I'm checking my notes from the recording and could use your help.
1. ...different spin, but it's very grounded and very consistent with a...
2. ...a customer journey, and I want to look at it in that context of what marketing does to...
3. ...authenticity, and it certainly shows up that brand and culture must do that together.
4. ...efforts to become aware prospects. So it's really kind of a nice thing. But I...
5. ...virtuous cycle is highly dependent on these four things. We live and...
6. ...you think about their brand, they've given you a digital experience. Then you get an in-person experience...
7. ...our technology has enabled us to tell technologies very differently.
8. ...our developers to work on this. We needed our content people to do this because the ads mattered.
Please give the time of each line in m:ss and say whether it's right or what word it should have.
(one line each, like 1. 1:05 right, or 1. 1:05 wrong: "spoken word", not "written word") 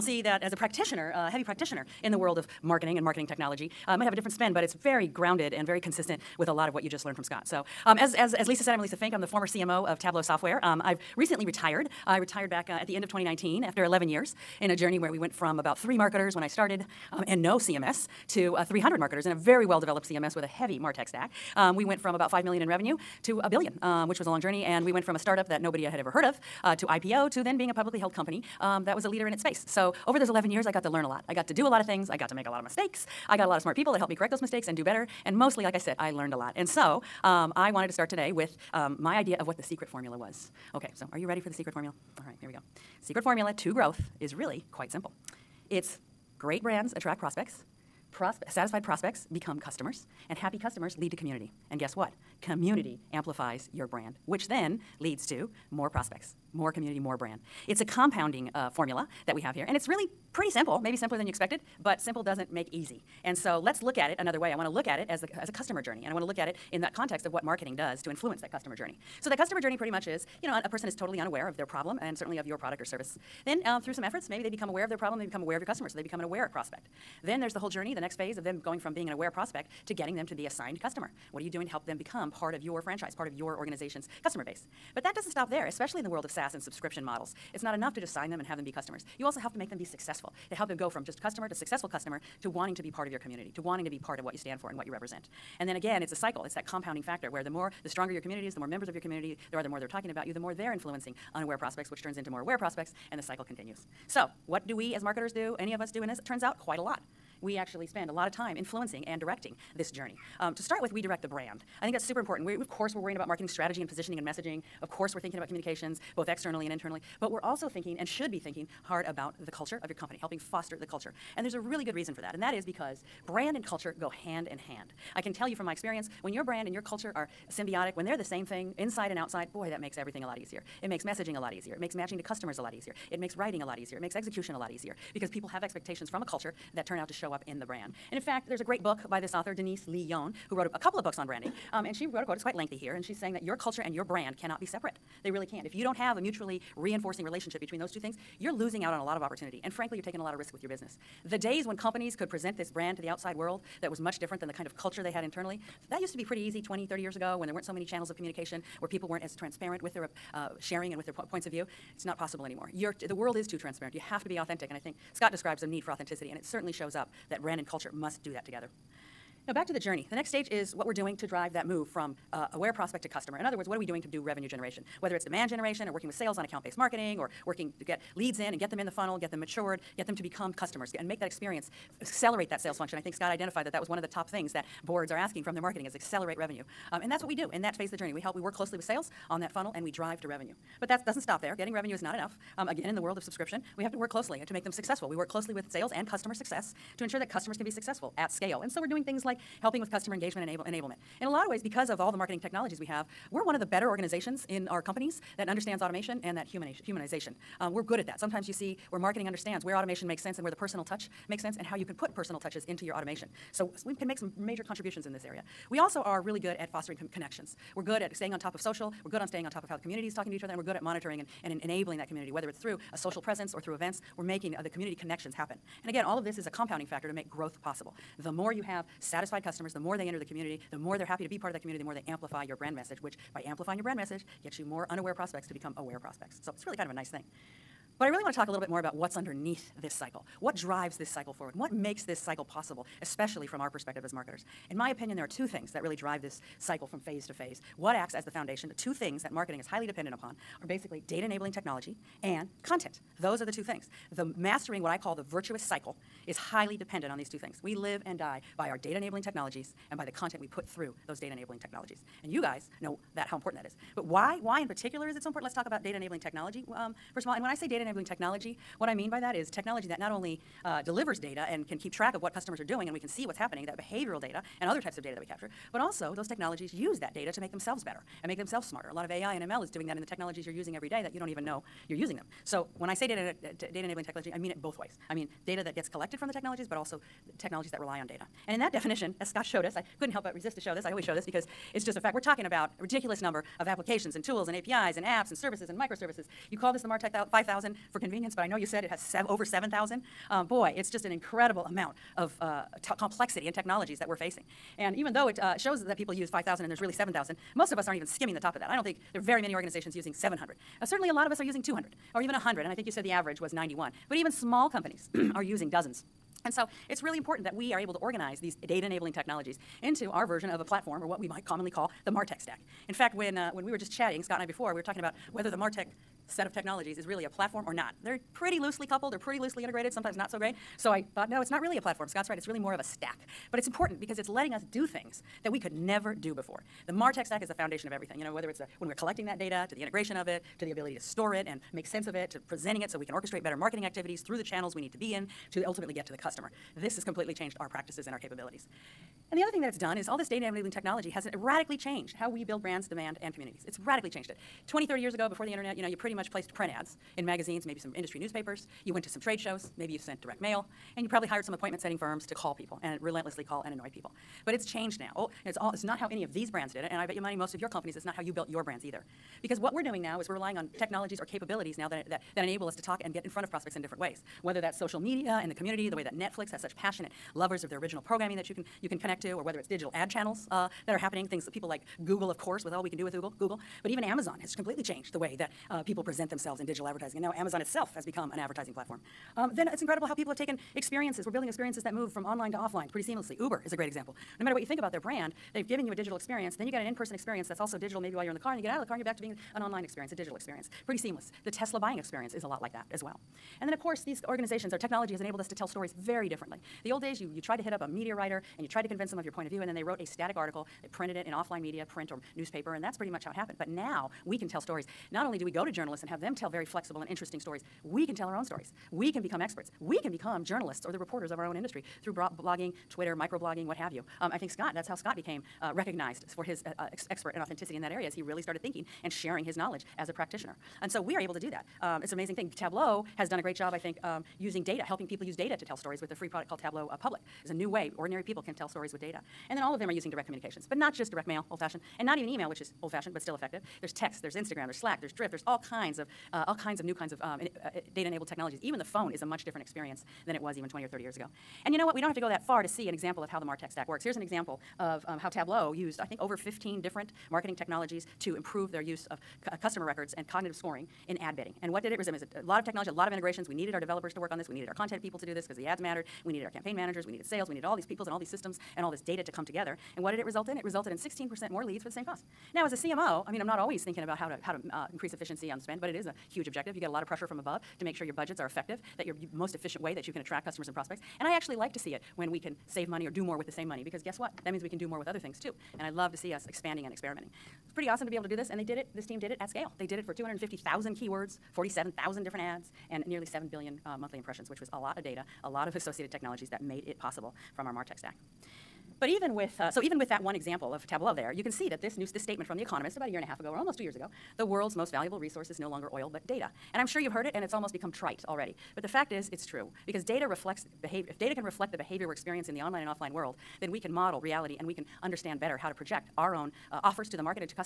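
1. 0:04 right
2. 1:05 right
3. 2:45 right
4. 3:55 wrong: "prospects", not "efforts"
5. 4:15 wrong: "two", not "four"
6. 6:34 right
7. 6:44 wrong: "stories", not "technologies"
8. 7:43 right.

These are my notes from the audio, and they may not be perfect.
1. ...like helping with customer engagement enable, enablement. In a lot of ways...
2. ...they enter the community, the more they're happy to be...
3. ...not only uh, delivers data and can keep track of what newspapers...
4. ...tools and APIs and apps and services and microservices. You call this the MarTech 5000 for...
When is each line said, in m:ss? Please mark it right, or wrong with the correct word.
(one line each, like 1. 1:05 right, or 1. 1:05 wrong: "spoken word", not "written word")
1. 3:19 right
2. 3:49 right
3. 4:29 wrong: "customers", not "newspapers"
4. 4:54 right.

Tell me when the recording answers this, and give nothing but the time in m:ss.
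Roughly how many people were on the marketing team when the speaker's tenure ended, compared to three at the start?
0:18.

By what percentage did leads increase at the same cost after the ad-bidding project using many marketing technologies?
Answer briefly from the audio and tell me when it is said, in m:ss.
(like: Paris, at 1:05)
16%, at 7:50.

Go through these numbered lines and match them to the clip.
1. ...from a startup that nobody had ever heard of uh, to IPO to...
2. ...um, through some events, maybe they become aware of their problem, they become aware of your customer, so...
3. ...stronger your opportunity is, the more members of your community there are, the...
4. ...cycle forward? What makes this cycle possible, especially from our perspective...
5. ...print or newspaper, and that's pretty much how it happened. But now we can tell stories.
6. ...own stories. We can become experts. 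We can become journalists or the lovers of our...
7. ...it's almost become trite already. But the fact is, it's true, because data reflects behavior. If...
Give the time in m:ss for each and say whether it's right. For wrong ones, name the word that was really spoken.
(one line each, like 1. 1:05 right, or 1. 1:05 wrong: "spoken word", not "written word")
1. 0:25 right
2. 1:13 wrong: "efforts", not "events"
3. 1:37 wrong: "community", not "opportunity"
4. 4:01 right
5. 6:51 right
6. 6:58 wrong: "reporters", not "lovers"
7. 8:27 right.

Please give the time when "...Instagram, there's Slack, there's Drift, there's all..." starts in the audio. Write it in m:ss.
7:24.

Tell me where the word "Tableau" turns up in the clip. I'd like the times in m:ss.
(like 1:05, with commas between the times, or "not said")
0:09, 7:12, 7:16, 7:35, 8:20.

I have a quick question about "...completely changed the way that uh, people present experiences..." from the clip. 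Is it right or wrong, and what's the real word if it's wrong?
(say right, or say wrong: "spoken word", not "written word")
wrong: "themselves", not "experiences".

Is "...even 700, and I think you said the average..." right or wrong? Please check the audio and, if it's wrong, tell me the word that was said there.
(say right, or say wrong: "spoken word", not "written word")
wrong: "100", not "700".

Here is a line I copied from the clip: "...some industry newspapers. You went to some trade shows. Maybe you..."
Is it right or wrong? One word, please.
right.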